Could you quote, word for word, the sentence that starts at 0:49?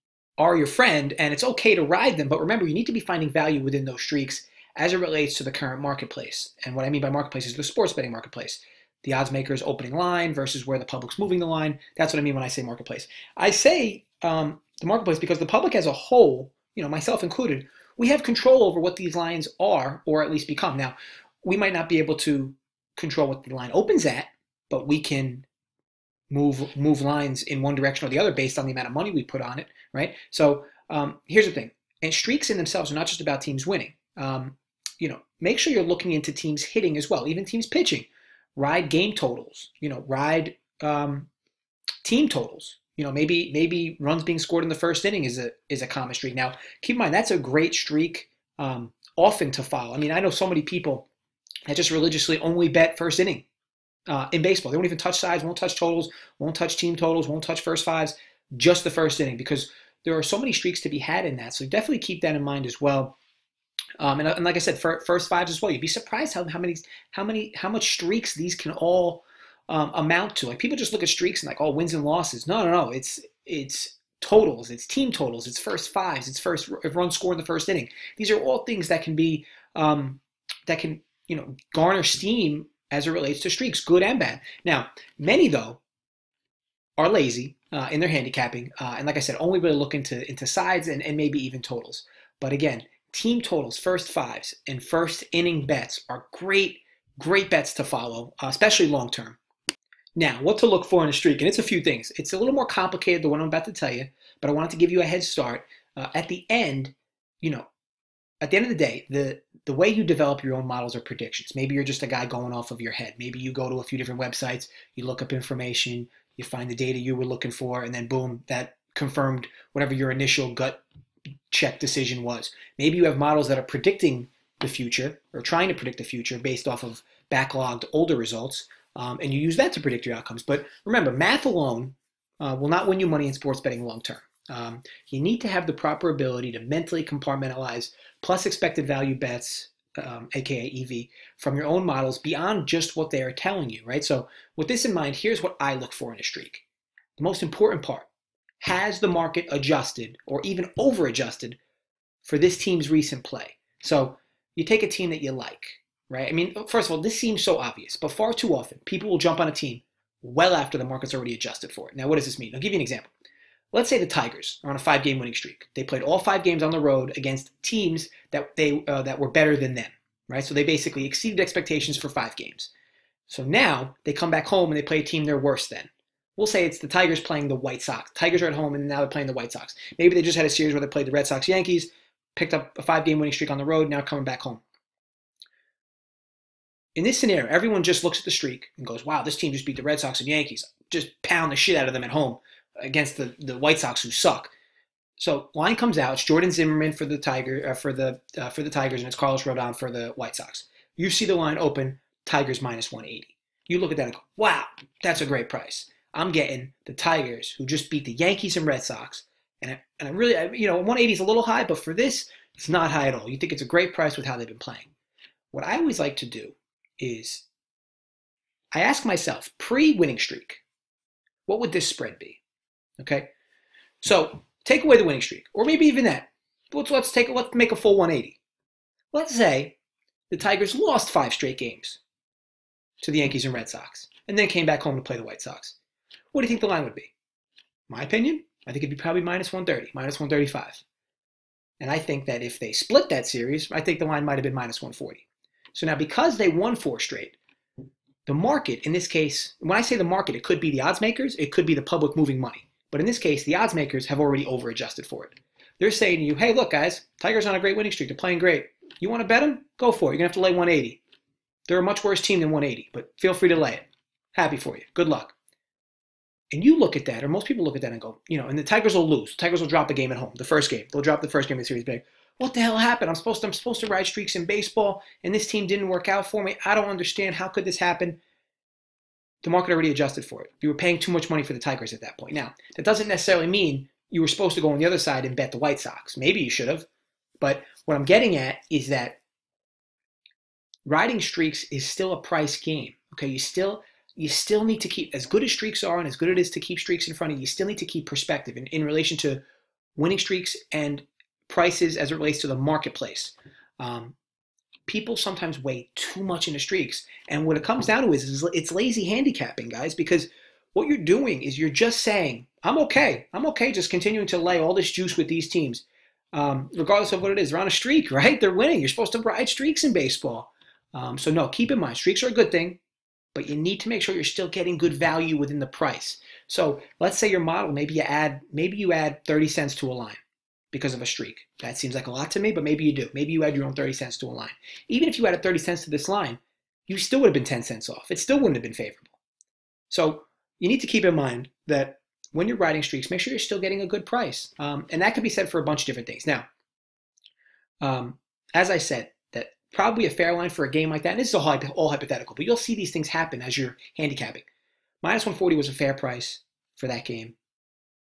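I mean, I know so many people that just religiously only bet first inning uh, in baseball.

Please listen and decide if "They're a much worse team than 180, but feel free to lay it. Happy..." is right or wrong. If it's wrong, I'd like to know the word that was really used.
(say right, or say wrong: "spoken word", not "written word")
right.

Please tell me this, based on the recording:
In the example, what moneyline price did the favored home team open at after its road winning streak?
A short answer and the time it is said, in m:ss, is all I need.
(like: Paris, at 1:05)
-180, at 3:22.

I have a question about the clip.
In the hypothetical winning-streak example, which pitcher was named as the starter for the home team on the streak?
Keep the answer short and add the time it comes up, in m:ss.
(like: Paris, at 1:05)
Jordan Zimmermann, at 3:16.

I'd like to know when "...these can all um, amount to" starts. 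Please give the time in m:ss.
1:08.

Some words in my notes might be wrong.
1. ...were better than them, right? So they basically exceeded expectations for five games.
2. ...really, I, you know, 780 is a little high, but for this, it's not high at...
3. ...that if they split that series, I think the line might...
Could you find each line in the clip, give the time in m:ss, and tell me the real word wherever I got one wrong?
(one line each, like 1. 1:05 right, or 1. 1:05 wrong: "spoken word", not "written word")
1. 2:49 right
2. 3:30 wrong: "180", not "780"
3. 4:02 right.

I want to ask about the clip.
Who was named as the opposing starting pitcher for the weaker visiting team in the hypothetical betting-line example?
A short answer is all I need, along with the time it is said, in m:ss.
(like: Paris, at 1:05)
Carlos Rodon, at 3:19.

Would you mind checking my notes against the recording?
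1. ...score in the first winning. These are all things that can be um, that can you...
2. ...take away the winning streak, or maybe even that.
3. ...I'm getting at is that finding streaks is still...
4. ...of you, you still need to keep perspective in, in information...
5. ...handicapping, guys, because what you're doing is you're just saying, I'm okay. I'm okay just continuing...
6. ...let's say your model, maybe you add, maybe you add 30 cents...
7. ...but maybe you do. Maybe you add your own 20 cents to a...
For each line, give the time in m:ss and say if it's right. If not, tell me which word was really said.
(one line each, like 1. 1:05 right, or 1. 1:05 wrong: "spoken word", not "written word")
1. 1:17 wrong: "inning", not "winning"
2. 3:44 right
3. 4:47 wrong: "riding", not "finding"
4. 4:57 wrong: "relation", not "information"
5. 5:09 right
6. 5:26 right
7. 5:32 wrong: "30", not "20".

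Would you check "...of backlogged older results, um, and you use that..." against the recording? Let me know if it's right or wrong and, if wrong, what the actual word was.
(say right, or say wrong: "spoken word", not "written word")
right.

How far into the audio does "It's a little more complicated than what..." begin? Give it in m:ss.
1:42.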